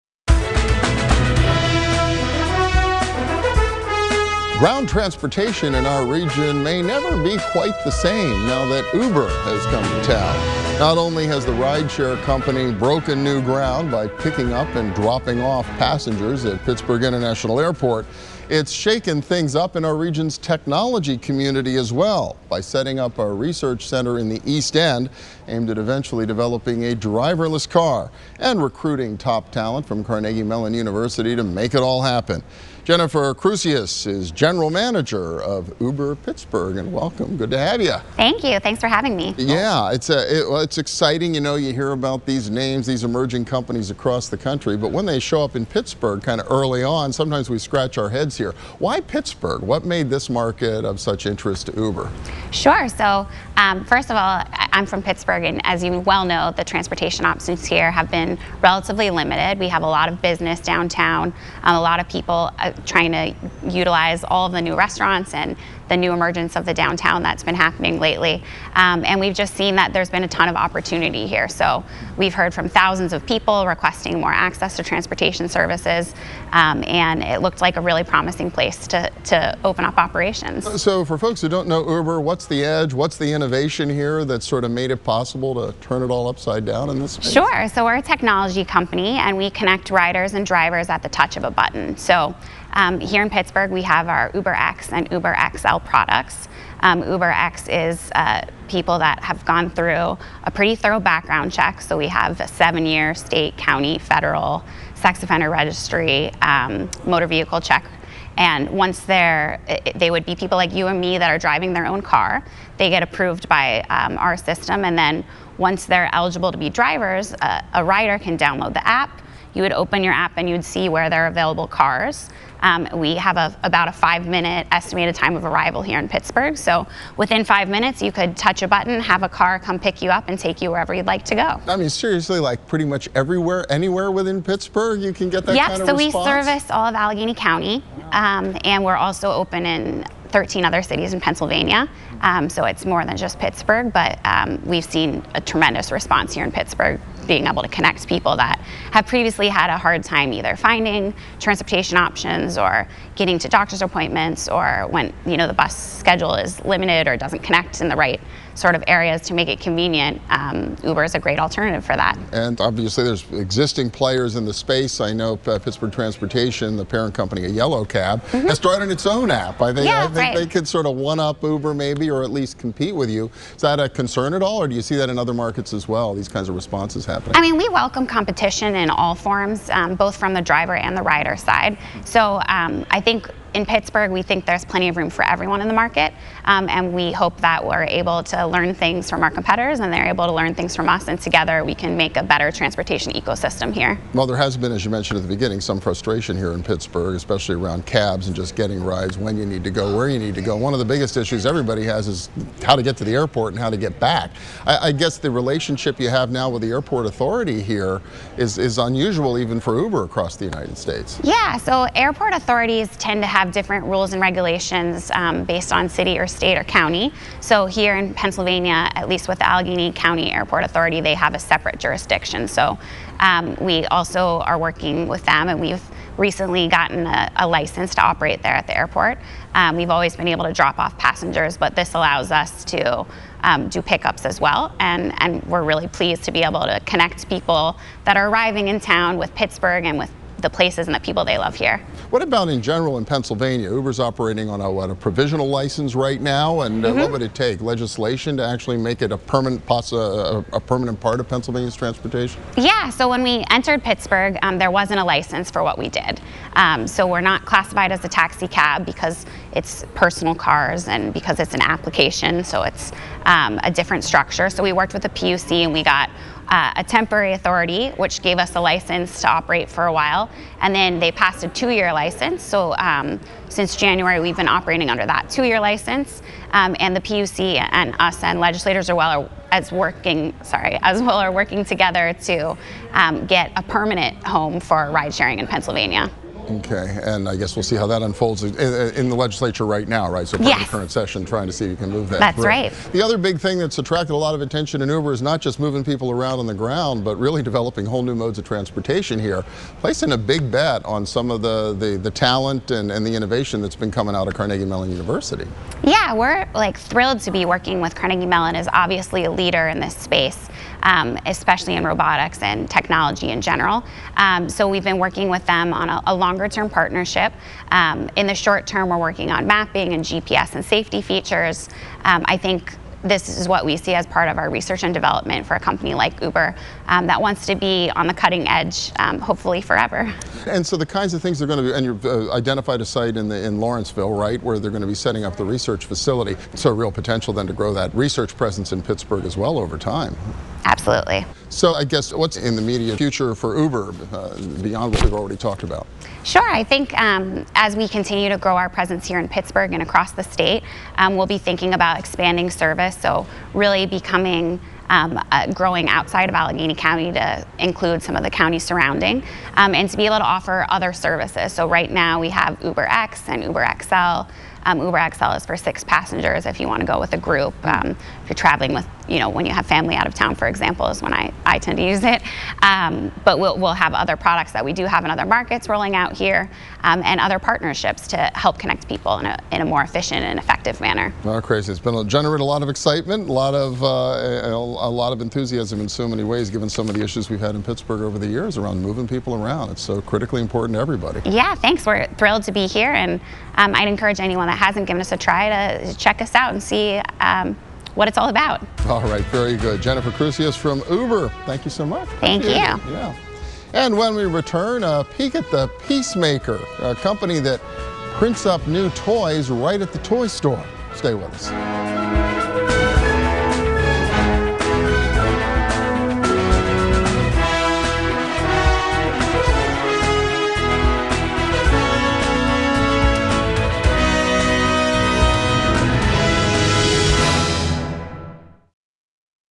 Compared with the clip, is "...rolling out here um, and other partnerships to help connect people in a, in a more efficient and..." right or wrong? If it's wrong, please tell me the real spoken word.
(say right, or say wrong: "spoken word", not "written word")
right.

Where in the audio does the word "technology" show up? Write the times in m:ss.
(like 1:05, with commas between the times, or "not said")
0:20, 1:28, 5:12.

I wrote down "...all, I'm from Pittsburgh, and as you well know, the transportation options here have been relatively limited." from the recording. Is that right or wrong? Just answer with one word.
right.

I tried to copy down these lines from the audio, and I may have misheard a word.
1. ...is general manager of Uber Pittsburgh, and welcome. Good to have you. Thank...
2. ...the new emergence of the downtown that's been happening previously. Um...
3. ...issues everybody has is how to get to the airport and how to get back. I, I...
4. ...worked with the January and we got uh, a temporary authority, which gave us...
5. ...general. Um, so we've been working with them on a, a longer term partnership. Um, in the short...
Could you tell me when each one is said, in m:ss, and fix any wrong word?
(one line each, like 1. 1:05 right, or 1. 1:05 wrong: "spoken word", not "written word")
1. 0:34 right
2. 1:05 wrong: "lately", not "previously"
3. 3:21 right
4. 4:24 wrong: "PUC", not "January"
5. 5:13 right.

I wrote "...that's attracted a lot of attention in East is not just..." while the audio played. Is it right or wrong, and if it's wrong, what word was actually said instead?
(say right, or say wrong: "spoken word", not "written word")
wrong: "Uber", not "East".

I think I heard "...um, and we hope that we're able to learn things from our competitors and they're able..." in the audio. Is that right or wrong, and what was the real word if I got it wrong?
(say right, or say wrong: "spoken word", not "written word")
right.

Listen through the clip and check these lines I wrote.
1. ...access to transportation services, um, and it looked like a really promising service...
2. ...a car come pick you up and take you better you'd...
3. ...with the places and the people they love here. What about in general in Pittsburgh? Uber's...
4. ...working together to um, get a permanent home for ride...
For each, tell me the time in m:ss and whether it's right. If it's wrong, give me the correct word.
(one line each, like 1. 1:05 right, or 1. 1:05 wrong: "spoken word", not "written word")
1. 1:14 wrong: "place", not "service"
2. 2:09 wrong: "wherever", not "better"
3. 3:59 wrong: "Pennsylvania", not "Pittsburgh"
4. 4:41 right.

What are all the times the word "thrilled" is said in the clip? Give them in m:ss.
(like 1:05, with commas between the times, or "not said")
5:06, 6:32.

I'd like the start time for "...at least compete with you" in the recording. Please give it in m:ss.
2:52.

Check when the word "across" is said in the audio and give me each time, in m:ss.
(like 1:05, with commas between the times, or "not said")
0:43, 3:30, 5:49.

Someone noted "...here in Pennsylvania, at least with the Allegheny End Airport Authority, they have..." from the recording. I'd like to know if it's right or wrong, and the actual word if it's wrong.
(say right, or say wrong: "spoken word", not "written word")
wrong: "County", not "End".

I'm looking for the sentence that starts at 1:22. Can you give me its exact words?
What's the innovation here that sort of made it possible to turn it all upside down in this space?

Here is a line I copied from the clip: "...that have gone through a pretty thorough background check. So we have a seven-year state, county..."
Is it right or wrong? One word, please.
right.